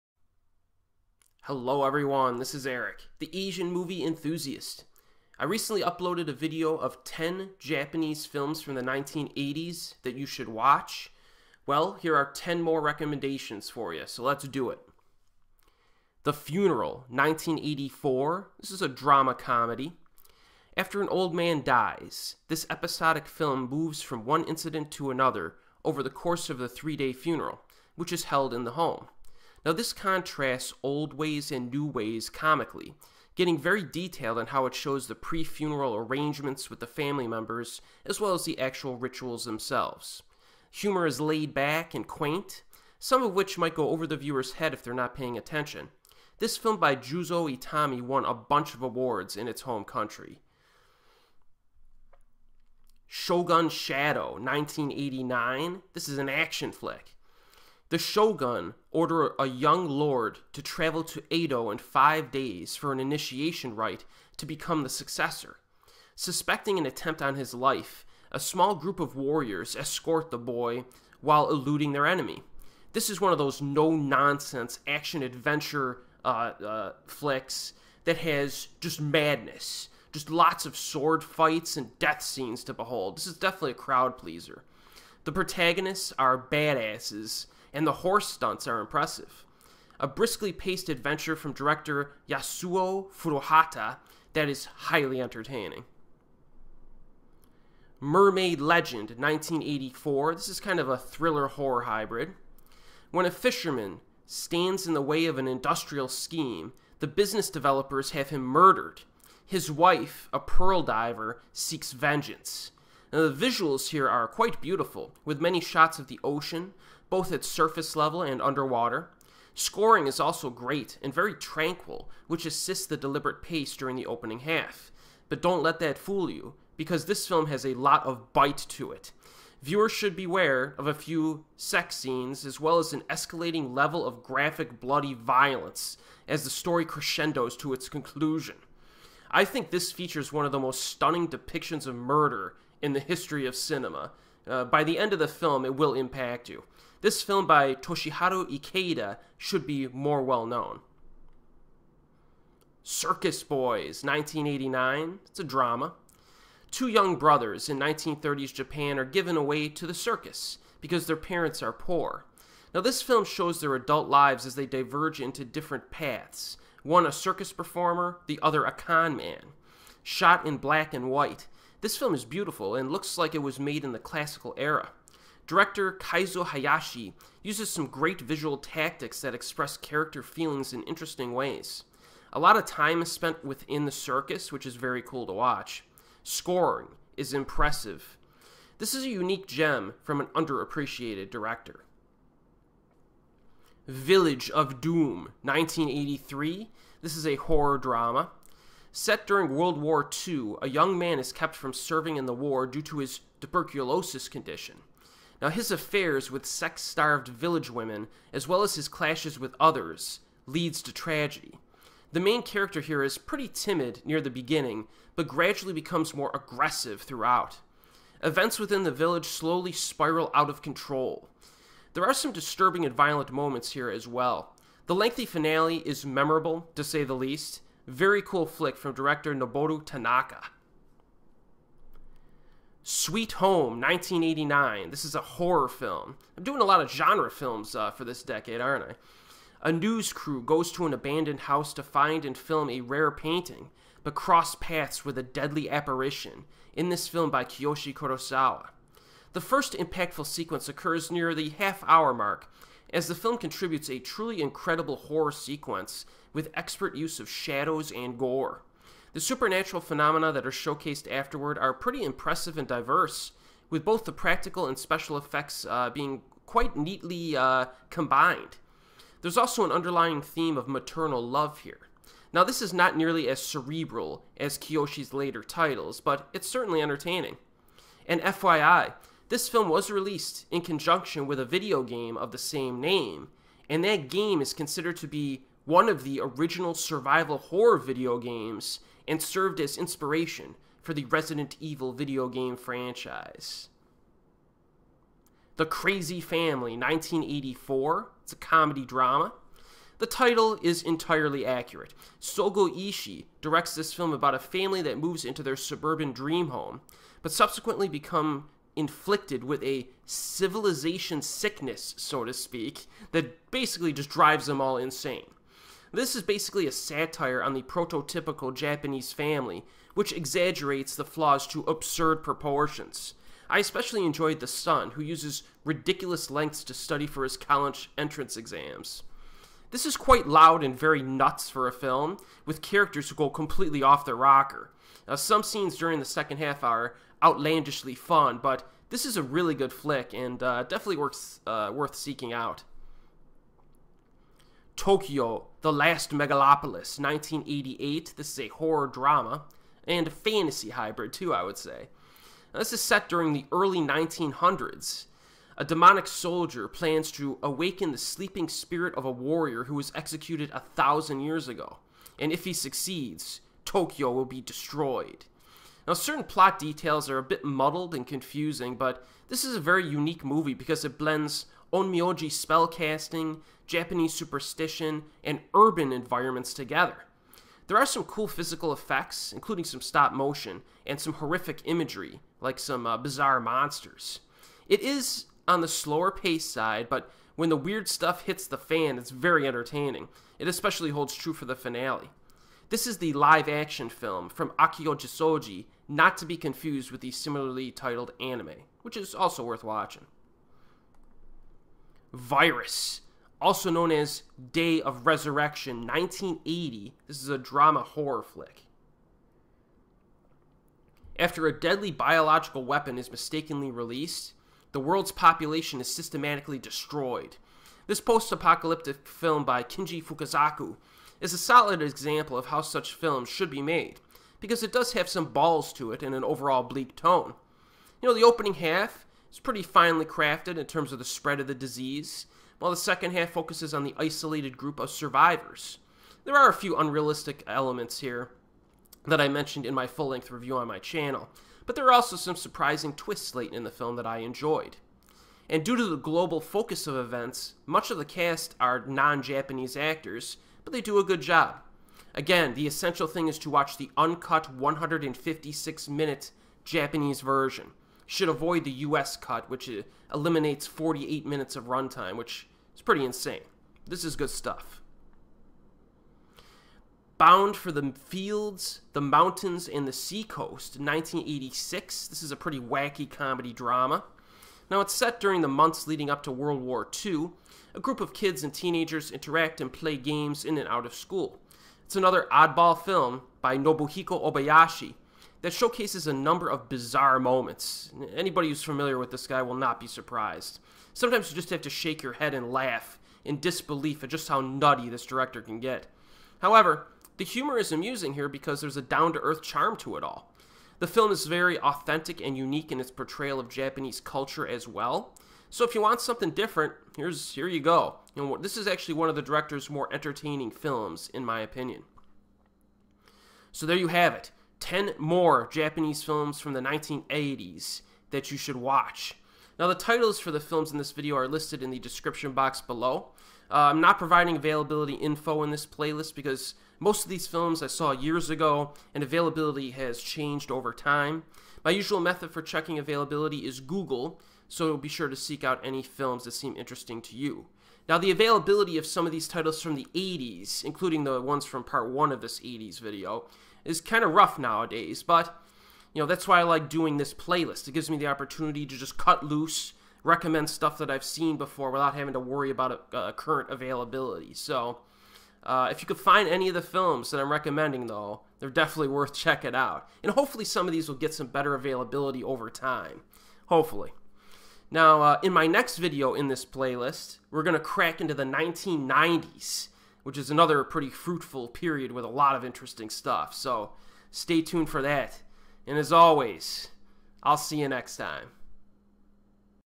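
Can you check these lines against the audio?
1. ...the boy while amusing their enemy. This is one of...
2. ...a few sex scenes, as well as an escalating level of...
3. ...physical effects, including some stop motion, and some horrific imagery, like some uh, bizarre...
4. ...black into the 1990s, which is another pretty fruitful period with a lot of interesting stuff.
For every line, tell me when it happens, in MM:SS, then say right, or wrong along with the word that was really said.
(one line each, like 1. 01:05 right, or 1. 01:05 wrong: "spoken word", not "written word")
1. 01:10 wrong: "eluding", not "amusing"
2. 02:10 right
3. 06:18 right
4. 09:27 wrong: "crack", not "black".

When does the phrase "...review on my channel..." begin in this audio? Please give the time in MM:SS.
07:20.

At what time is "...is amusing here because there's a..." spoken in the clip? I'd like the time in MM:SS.
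08:17.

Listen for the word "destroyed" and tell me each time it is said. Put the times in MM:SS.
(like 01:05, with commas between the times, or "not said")
06:04, 06:56.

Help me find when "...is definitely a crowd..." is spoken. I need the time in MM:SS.
01:23.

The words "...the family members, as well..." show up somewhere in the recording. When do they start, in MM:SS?
00:36.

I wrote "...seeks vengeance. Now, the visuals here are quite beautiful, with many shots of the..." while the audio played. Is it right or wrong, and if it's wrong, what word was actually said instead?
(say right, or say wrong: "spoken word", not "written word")
right.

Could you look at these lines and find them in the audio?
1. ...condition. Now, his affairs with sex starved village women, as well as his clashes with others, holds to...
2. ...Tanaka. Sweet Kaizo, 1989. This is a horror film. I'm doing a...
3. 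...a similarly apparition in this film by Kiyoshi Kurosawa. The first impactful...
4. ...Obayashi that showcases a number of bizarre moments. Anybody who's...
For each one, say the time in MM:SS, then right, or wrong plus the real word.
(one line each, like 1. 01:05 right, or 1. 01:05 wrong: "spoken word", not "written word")
1. 03:24 wrong: "leads", not "holds"
2. 03:49 wrong: "Home", not "Kaizo"
3. 04:05 wrong: "deadly", not "similarly"
4. 08:04 right.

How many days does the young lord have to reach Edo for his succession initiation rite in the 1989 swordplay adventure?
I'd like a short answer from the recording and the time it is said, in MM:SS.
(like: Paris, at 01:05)
5, at 01:01.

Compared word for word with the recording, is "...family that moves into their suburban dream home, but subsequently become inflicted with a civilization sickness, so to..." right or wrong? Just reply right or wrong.
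right.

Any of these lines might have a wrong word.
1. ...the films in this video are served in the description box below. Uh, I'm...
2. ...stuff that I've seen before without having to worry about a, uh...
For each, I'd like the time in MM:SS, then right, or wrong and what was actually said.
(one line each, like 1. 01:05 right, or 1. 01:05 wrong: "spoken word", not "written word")
1. 08:40 wrong: "listed", not "served"
2. 09:10 right.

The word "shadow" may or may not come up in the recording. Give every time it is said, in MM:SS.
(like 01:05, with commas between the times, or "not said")
00:53, 04:17.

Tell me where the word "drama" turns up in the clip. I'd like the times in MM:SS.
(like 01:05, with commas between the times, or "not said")
00:18, 02:35, 03:17, 04:58, 05:48, 06:47, 07:53.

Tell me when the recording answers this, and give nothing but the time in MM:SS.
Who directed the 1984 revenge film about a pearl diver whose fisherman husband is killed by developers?
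02:27.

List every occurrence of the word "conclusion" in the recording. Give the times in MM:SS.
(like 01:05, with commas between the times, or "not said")
02:17.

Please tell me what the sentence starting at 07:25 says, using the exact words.
And due to the global focus of events, much of the cast are non Japanese actors, but they do a good job.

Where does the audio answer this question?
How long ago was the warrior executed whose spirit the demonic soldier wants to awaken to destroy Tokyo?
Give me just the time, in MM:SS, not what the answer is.
06:00.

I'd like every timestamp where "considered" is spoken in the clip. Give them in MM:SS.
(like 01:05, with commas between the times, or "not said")
04:44.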